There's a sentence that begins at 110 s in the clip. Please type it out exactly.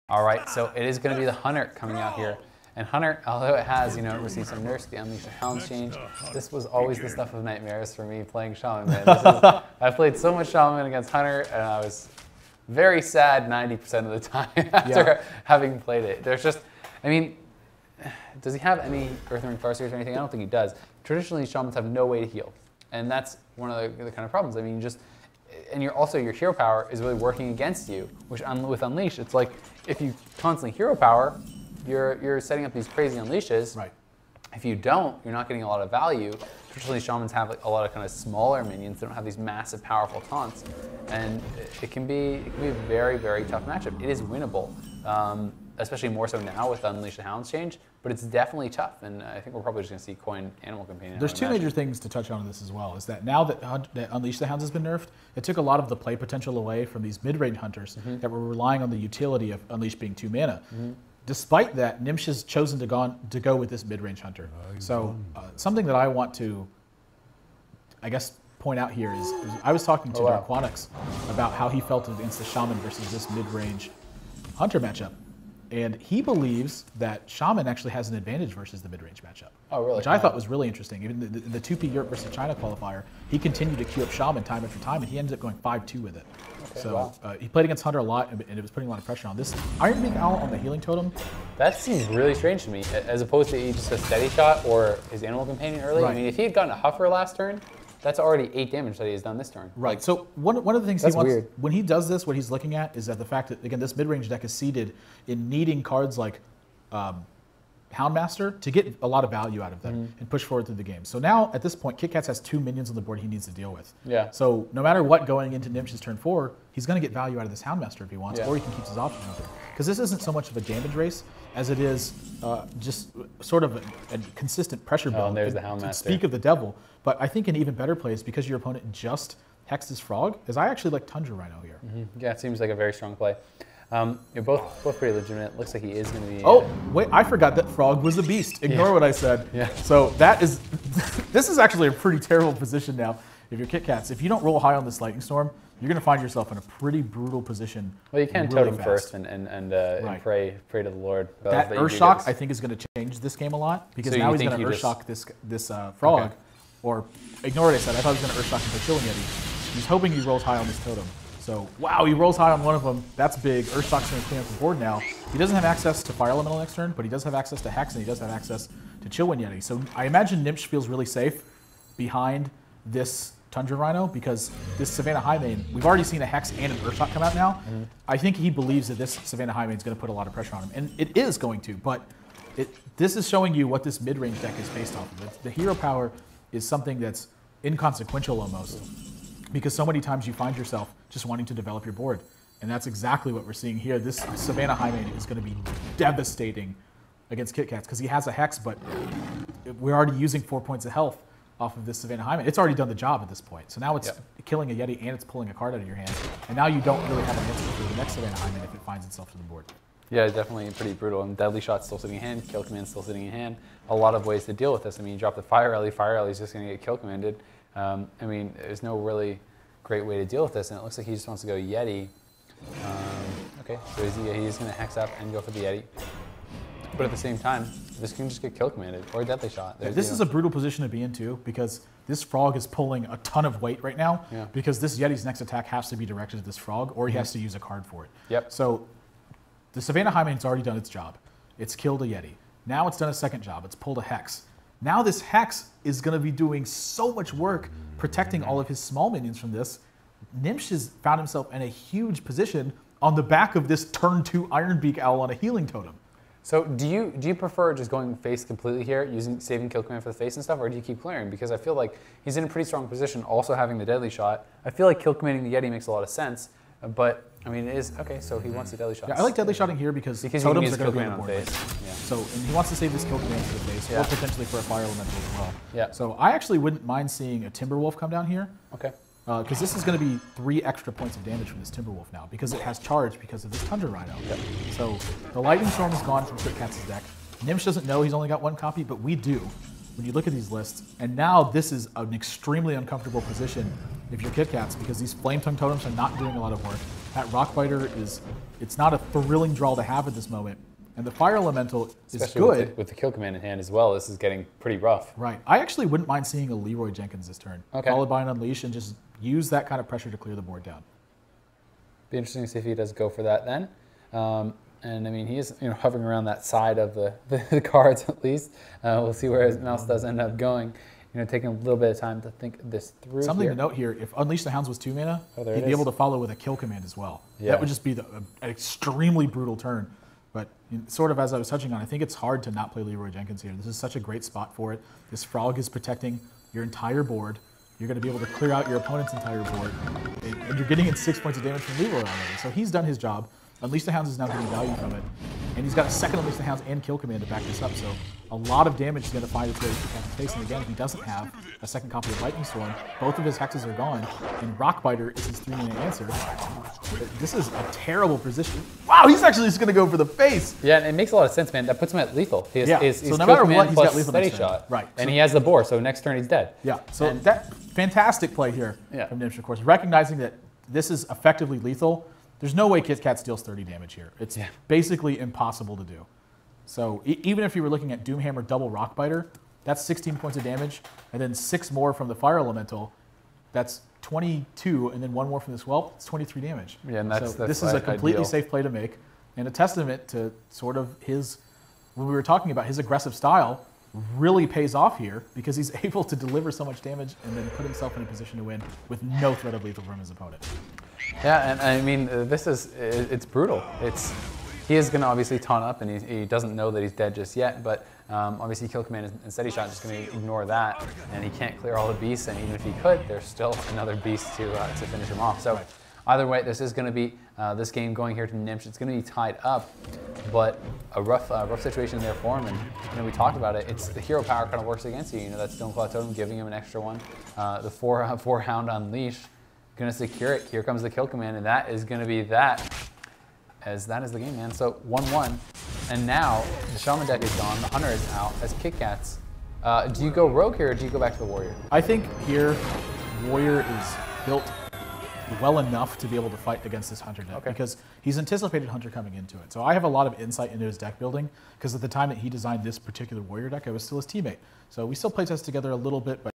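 and push forward through the game.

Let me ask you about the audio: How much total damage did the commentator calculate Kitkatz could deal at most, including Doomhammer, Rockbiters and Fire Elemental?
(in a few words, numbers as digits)
23.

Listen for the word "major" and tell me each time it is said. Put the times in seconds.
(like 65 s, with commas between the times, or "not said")
51 s.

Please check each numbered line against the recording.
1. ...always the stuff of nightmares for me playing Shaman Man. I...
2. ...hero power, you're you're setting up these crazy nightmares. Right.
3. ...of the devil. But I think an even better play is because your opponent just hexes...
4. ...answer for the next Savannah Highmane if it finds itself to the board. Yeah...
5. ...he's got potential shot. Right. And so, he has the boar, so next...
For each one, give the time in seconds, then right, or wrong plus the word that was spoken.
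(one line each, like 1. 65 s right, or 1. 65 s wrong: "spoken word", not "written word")
1. 6 s right
2. 30 s wrong: "unleashes", not "nightmares"
3. 126 s right
4. 207 s right
5. 363 s wrong: "lethal", not "potential".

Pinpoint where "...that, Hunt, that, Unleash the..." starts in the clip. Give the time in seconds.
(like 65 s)
53 s.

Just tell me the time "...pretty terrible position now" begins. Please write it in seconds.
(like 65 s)
141 s.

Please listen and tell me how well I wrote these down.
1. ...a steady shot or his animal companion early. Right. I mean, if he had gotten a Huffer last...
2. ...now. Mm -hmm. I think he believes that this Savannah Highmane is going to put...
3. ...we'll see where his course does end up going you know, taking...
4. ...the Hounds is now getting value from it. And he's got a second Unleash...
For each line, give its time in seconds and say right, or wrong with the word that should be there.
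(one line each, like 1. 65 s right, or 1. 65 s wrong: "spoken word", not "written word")
1. 93 s right
2. 177 s right
3. 319 s wrong: "mouse", not "course"
4. 343 s right.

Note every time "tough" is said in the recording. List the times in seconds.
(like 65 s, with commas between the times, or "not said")
43 s, 48 s.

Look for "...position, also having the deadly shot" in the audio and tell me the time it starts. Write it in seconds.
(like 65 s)
262 s.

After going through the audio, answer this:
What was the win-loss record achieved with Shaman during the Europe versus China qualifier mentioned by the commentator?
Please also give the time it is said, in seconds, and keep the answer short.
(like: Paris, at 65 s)
5-2, at 85 s.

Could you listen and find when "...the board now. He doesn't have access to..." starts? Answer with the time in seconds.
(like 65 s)
164 s.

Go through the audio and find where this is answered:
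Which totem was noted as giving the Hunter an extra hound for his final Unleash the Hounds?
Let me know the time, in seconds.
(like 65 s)
425 s.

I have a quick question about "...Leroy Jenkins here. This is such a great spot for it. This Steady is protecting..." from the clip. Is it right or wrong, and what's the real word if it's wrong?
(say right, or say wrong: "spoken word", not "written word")
wrong: "Frog", not "Steady".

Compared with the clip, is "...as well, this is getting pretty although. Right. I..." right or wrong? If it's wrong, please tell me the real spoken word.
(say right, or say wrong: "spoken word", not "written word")
wrong: "rough", not "although".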